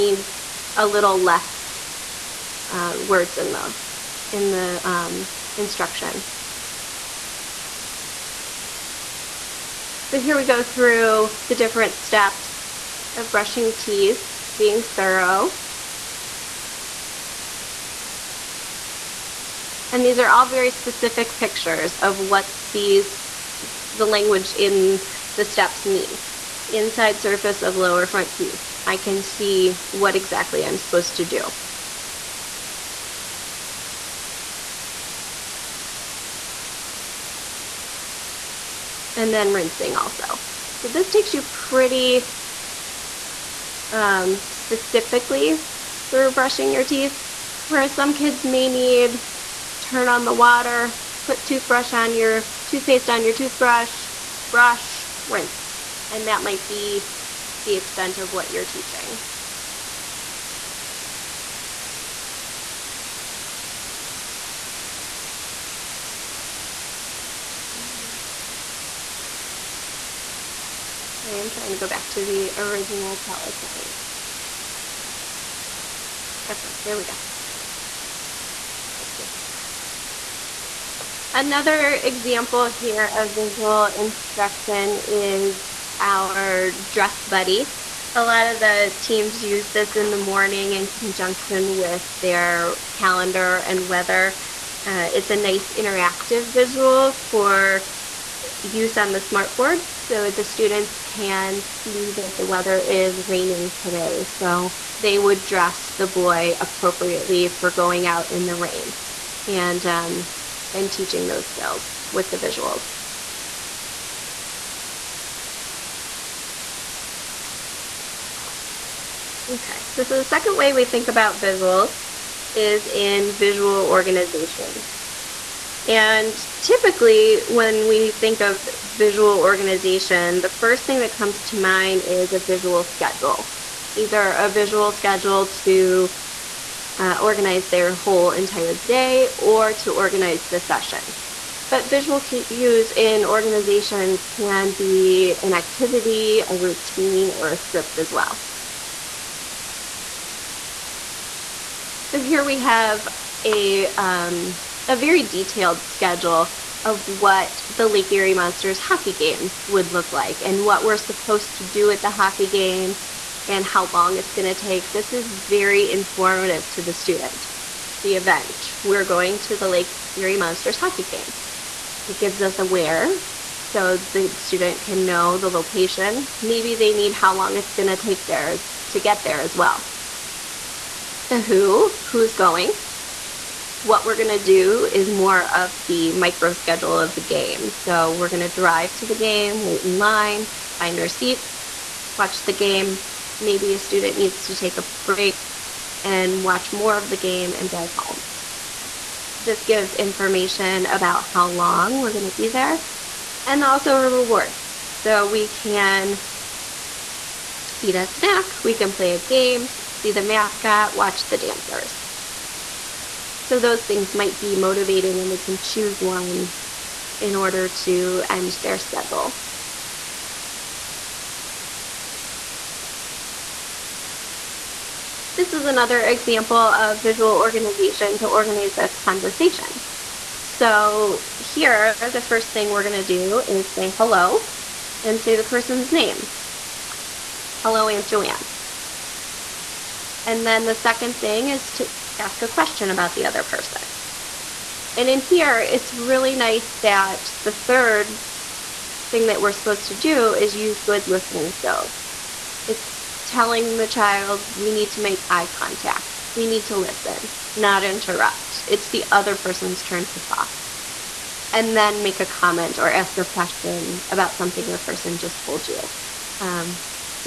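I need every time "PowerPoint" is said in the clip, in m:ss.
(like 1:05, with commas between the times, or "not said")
1:13.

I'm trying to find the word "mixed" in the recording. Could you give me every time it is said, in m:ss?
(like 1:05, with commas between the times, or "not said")
not said.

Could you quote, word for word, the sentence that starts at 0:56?
And that might be the extent of what you're teaching.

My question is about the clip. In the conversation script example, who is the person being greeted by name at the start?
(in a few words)
Aunt Joanne.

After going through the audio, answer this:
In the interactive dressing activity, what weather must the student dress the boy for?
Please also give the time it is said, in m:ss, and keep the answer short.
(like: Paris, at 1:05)
raining, at 1:43.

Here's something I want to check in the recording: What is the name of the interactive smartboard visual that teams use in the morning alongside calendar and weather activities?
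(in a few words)
dress buddy.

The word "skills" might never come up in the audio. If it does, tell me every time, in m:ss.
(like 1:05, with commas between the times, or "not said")
1:51, 4:11.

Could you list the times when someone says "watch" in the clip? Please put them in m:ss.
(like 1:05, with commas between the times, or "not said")
3:12, 3:16, 3:30.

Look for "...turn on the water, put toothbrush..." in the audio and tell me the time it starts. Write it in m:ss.
0:49.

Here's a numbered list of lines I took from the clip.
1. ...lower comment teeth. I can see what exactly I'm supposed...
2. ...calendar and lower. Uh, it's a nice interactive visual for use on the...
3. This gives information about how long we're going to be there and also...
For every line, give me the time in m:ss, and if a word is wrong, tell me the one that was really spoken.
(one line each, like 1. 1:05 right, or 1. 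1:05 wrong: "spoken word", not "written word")
1. 0:27 wrong: "front", not "comment"
2. 1:32 wrong: "weather", not "lower"
3. 3:19 right.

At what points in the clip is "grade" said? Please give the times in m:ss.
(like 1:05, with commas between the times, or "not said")
not said.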